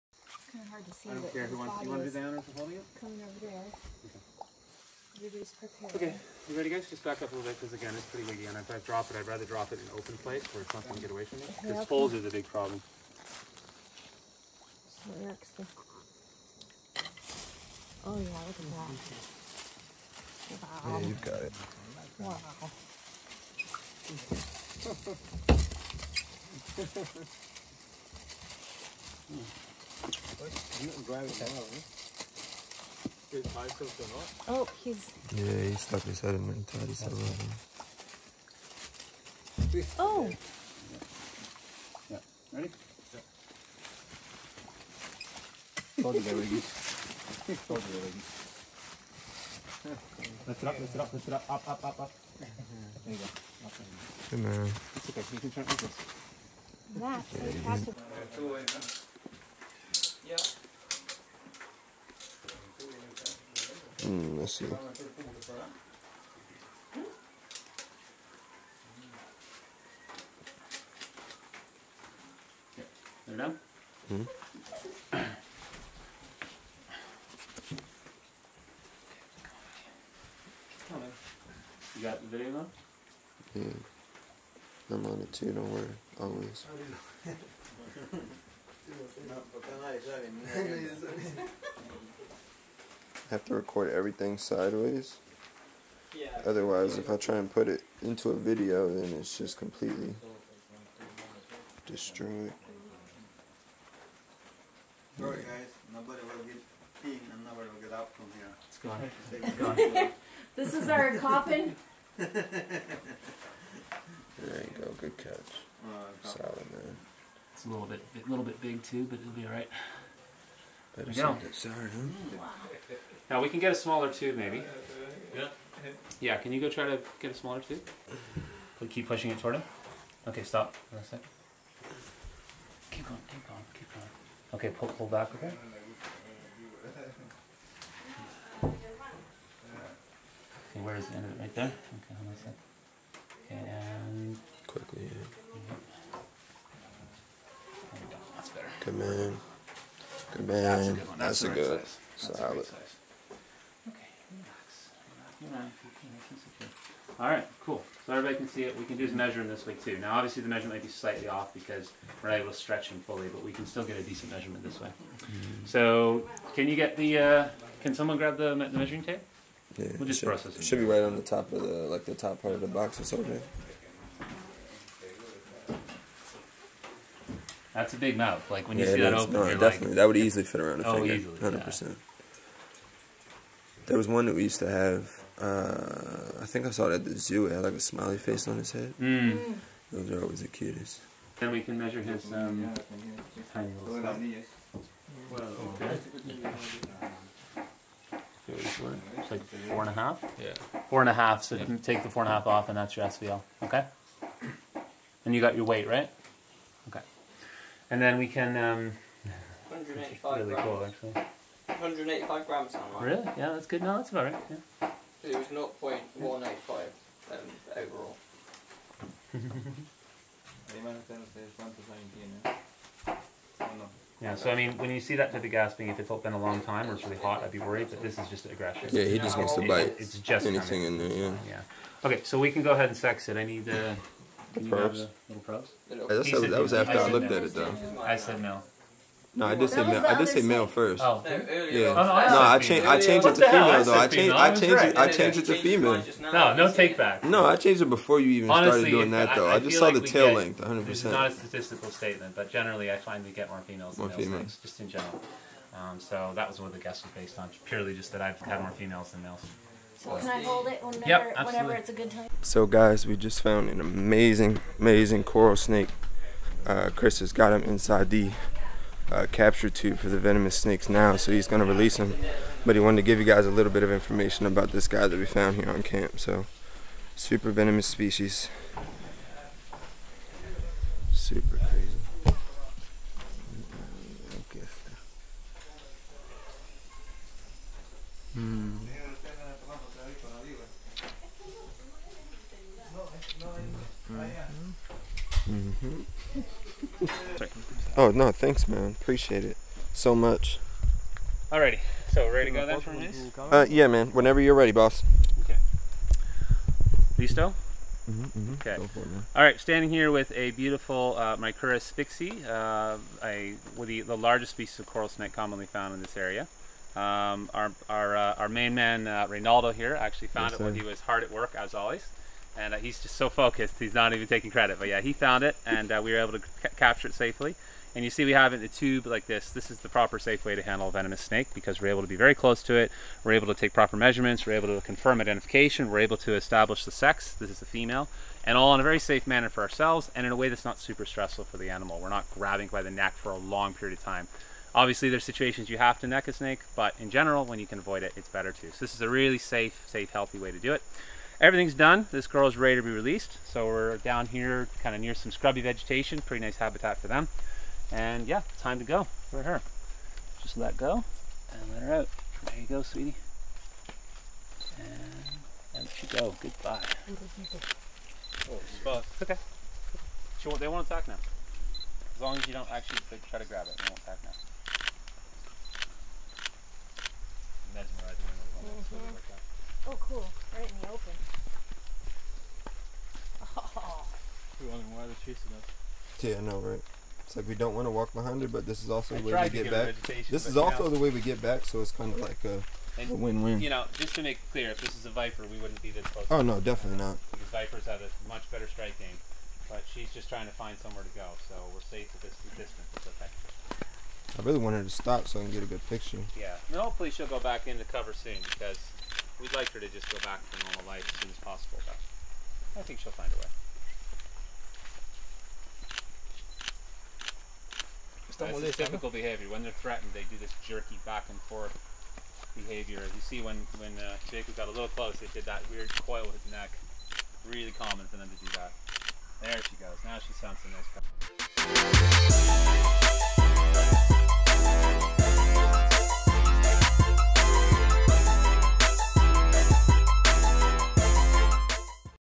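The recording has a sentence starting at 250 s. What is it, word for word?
This is not a statistical statement, but generally I find we get more females More than males, females.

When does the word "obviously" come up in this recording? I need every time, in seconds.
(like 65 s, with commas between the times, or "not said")
160 s, 344 s.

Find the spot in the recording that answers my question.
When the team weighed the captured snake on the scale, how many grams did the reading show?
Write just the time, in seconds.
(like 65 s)
211 s.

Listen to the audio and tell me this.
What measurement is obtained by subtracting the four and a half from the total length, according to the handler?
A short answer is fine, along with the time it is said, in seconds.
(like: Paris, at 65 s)
SVL, at 203 s.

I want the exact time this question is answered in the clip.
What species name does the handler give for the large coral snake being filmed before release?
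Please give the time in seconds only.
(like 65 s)
311 s.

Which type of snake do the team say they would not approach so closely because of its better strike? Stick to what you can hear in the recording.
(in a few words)
viper.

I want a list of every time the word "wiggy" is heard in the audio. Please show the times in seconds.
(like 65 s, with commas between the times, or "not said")
8 s.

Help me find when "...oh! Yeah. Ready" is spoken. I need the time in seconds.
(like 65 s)
39 s.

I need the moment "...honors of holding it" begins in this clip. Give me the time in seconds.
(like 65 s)
2 s.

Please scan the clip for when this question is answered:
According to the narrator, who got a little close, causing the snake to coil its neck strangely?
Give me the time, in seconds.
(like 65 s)
424 s.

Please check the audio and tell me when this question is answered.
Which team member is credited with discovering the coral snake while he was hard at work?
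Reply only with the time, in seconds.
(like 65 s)
319 s.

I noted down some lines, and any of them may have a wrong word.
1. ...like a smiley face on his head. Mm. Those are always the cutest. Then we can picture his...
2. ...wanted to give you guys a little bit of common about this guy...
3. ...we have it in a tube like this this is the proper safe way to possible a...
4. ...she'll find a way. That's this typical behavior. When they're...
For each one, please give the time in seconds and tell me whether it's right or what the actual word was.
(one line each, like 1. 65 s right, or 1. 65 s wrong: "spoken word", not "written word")
1. 187 s wrong: "measure", not "picture"
2. 272 s wrong: "information", not "common"
3. 328 s wrong: "handle", not "possible"
4. 412 s right.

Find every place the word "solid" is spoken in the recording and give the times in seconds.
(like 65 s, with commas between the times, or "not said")
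116 s, 152 s.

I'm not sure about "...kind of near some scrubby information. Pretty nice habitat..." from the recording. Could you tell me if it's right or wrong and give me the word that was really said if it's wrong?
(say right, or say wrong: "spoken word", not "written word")
wrong: "vegetation", not "information".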